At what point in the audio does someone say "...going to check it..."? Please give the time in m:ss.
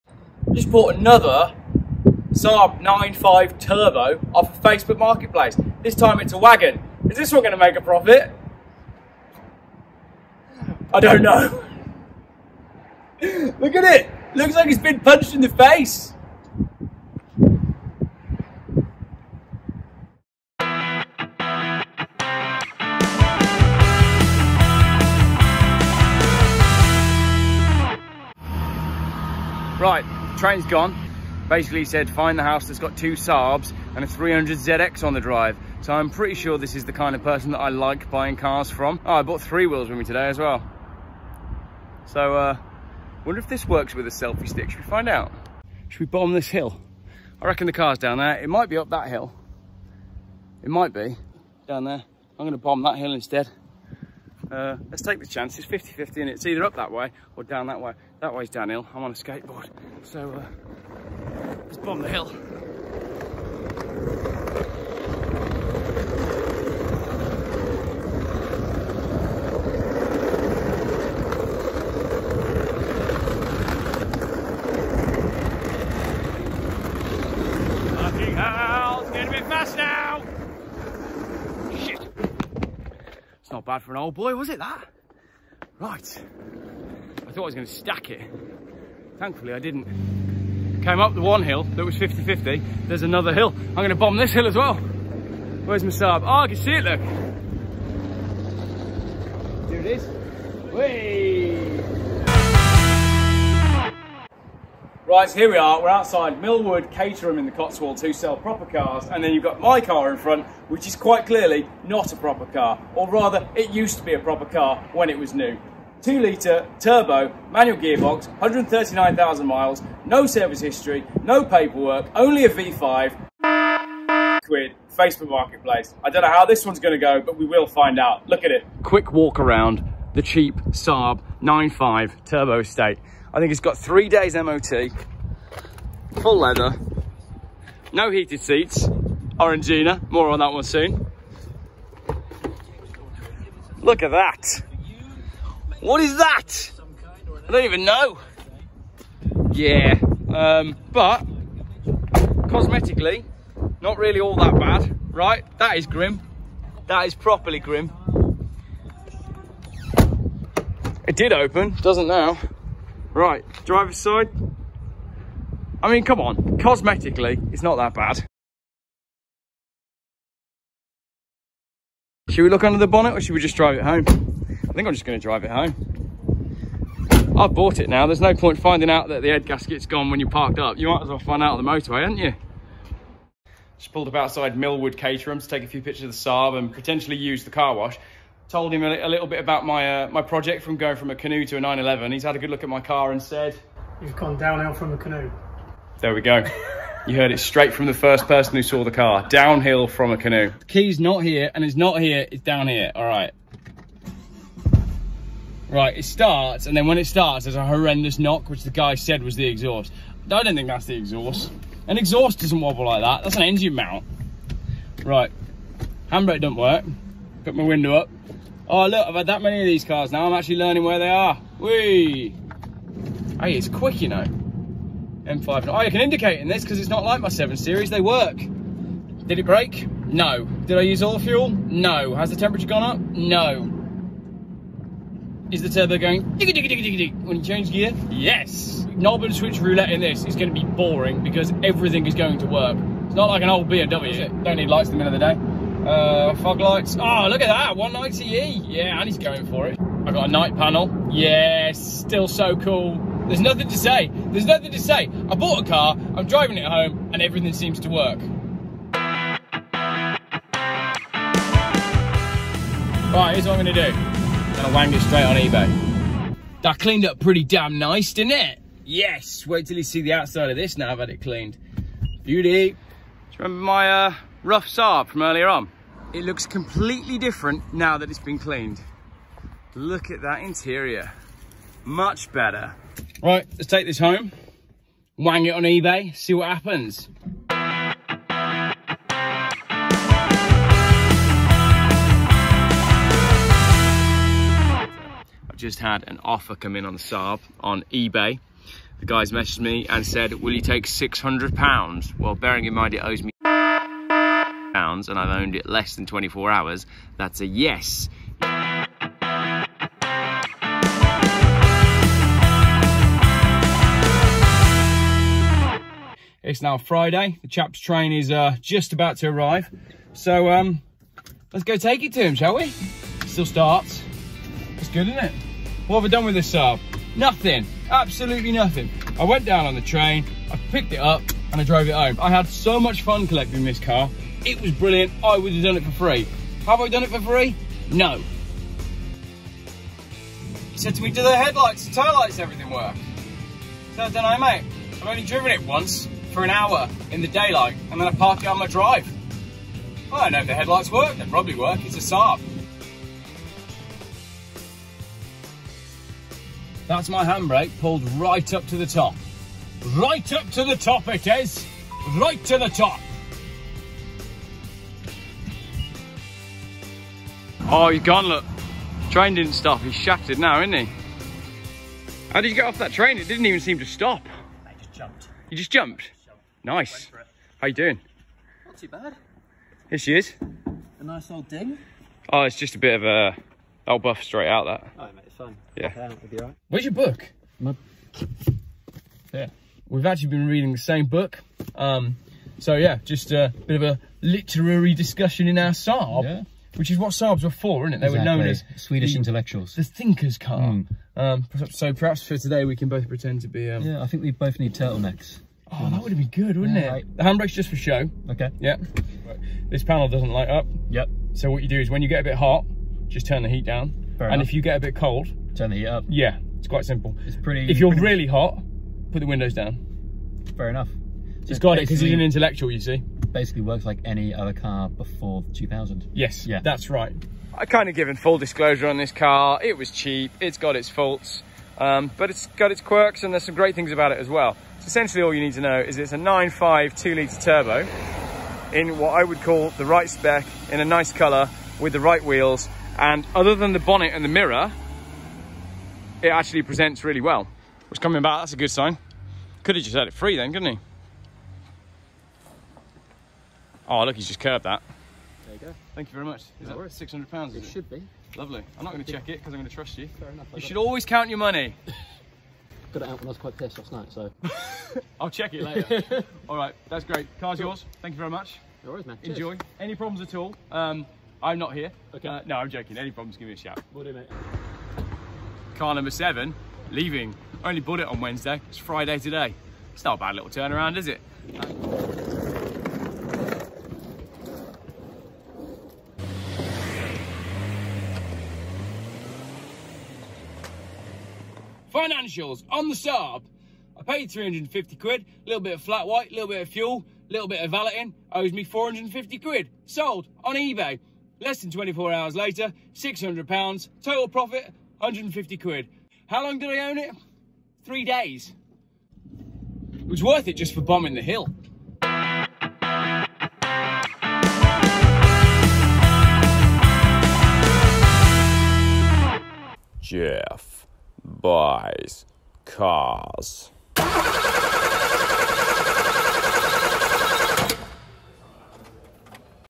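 7:38.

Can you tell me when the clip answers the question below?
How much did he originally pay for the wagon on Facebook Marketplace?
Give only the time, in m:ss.
8:14.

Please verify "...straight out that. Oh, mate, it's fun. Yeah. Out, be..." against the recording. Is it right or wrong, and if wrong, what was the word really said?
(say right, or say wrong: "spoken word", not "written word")
right.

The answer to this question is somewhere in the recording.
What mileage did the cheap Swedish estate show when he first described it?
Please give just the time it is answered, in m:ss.
1:58.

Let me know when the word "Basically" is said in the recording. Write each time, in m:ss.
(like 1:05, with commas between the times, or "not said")
0:31, 7:03.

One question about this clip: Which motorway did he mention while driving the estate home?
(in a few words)
M5.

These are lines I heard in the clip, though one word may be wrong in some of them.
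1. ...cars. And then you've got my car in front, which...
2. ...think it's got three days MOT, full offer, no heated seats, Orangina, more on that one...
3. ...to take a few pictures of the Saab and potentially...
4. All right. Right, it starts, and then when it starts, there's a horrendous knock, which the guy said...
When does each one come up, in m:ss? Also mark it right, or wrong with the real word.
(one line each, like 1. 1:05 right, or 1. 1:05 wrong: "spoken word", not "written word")
1. 1:48 right
2. 2:13 wrong: "leather", not "offer"
3. 3:05 right
4. 3:22 right.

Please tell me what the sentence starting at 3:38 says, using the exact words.
Oh, look, I've had that many of these cars now.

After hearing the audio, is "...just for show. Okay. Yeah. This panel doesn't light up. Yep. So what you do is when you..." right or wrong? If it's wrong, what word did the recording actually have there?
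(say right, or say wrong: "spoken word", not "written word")
right.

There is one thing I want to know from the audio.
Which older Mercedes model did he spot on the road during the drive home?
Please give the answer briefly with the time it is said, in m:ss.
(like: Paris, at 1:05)
190E, at 4:07.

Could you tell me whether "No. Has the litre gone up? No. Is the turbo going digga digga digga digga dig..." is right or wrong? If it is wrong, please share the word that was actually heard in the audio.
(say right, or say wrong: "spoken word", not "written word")
wrong: "temperature", not "litre".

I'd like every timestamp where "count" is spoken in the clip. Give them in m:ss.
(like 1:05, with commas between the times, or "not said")
7:41.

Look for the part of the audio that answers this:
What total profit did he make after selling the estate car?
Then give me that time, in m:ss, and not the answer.
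8:24.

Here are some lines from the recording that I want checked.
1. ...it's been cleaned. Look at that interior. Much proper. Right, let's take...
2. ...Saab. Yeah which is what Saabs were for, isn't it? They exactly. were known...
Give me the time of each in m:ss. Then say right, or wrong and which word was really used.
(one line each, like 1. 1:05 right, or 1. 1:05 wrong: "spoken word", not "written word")
1. 4:38 wrong: "better", not "proper"
2. 6:35 right.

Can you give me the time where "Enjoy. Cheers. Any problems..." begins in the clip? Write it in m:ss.
7:49.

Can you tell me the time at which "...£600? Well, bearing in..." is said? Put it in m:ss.
5:00.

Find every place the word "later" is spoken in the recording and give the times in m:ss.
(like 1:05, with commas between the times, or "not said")
7:45, 8:22.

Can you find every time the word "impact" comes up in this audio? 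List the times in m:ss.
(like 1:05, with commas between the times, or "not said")
not said.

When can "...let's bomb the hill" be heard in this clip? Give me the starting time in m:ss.
1:01.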